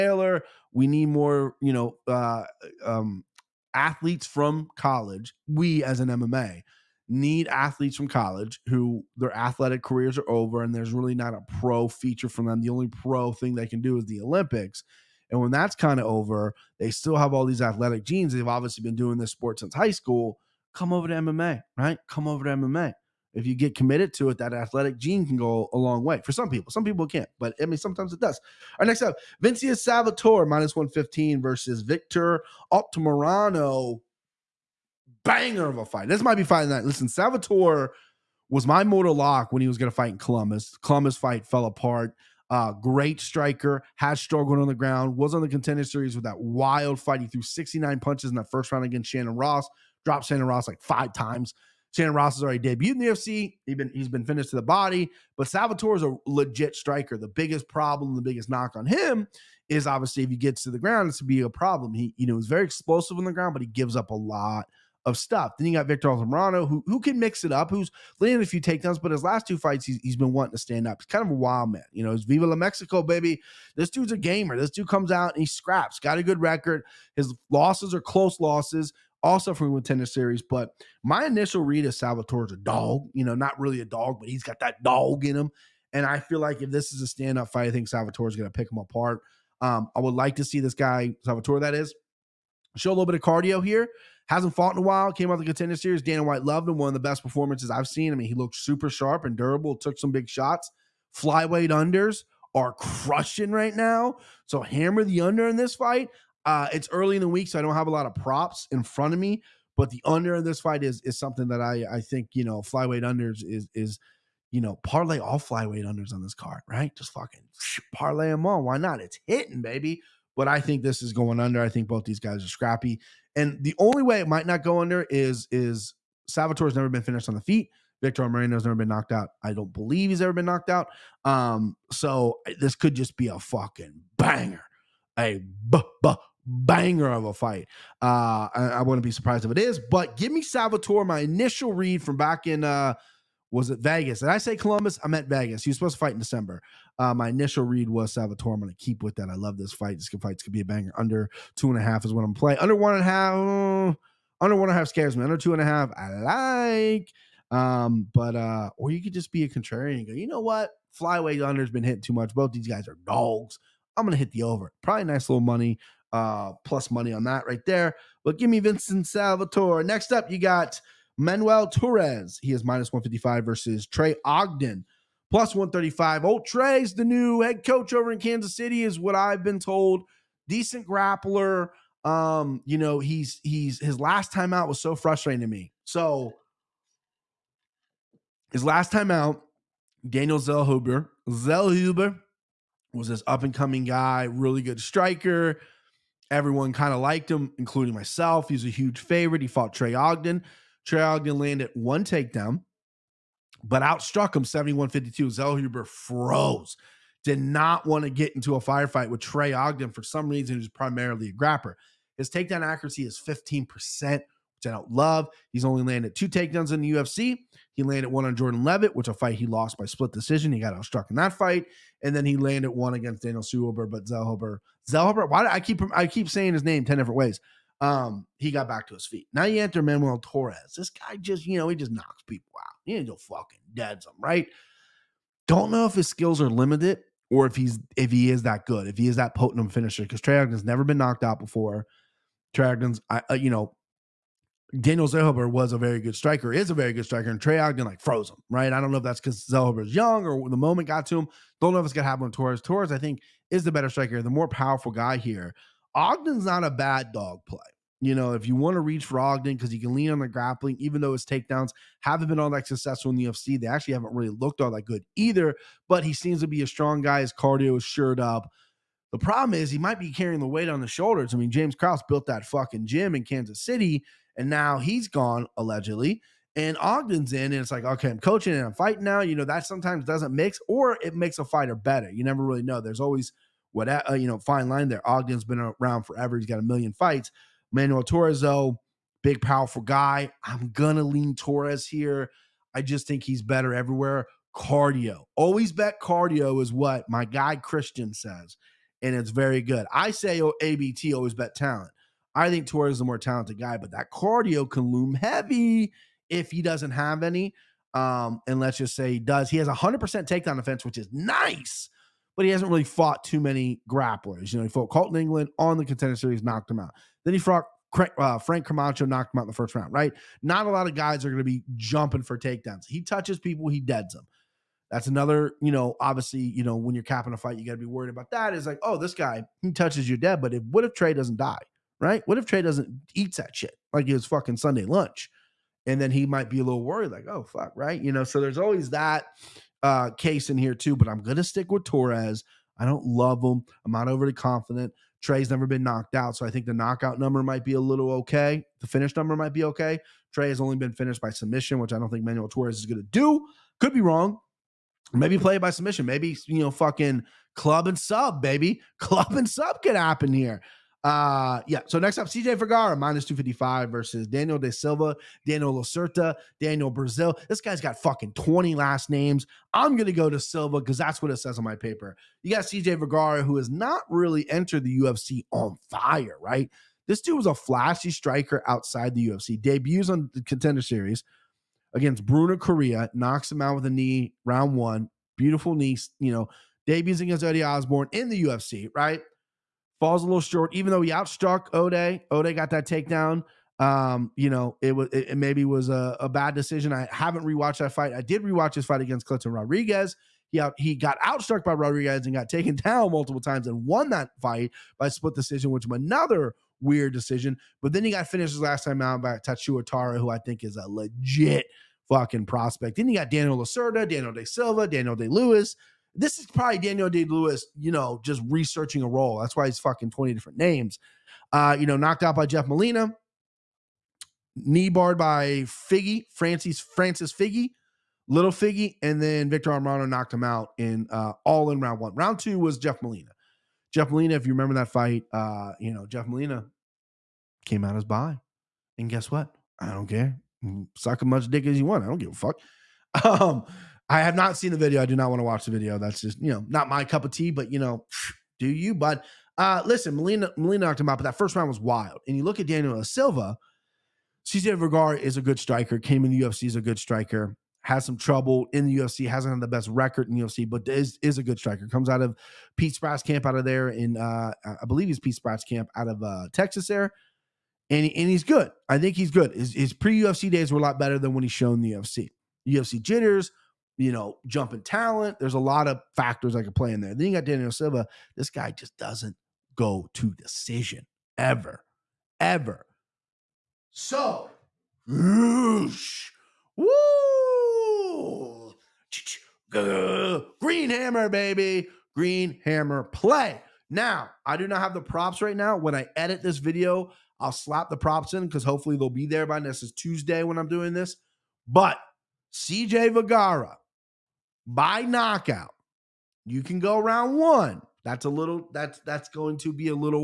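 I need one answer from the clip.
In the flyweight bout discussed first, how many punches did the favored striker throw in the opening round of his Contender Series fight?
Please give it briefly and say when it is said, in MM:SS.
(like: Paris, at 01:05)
69, at 00:47.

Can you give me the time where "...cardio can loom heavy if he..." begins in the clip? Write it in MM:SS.
05:04.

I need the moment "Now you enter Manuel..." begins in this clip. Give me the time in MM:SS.
03:49.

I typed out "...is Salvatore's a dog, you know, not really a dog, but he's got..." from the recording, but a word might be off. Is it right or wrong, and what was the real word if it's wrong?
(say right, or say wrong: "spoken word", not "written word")
right.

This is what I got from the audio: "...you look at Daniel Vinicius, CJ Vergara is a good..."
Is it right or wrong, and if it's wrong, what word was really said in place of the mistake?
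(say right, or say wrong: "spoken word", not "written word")
wrong: "Silva", not "Vinicius".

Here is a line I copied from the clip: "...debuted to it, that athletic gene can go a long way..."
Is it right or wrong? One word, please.
wrong.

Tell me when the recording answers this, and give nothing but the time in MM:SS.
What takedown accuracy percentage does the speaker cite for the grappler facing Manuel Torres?
03:33.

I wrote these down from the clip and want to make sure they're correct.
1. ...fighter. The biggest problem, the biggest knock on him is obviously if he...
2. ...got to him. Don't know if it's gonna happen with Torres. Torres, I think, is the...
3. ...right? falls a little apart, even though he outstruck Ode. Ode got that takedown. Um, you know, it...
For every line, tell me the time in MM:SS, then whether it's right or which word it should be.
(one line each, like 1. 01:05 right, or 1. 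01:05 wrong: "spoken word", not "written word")
1. 00:56 wrong: "striker", not "fighter"
2. 04:10 right
3. 06:28 wrong: "short", not "apart".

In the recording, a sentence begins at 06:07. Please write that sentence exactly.
This guy's got fucking 20 last names.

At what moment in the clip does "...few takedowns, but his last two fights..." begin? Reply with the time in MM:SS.
01:08.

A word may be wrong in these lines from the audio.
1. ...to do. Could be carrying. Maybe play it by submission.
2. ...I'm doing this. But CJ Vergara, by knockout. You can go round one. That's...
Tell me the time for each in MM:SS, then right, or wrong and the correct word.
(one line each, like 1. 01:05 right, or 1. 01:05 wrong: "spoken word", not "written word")
1. 05:52 wrong: "wrong", not "carrying"
2. 08:20 right.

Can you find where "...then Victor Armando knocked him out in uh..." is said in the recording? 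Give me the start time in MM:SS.
07:09.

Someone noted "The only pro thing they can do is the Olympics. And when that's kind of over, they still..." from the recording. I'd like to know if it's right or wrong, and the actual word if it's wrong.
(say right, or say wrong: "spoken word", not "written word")
right.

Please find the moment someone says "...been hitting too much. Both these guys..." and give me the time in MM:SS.
02:41.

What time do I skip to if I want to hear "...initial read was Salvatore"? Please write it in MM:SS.
02:27.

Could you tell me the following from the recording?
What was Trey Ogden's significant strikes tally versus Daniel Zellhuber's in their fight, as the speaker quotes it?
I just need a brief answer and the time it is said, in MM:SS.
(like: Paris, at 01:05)
71-52, at 03:24.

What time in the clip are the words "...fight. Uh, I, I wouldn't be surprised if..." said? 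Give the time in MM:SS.
02:17.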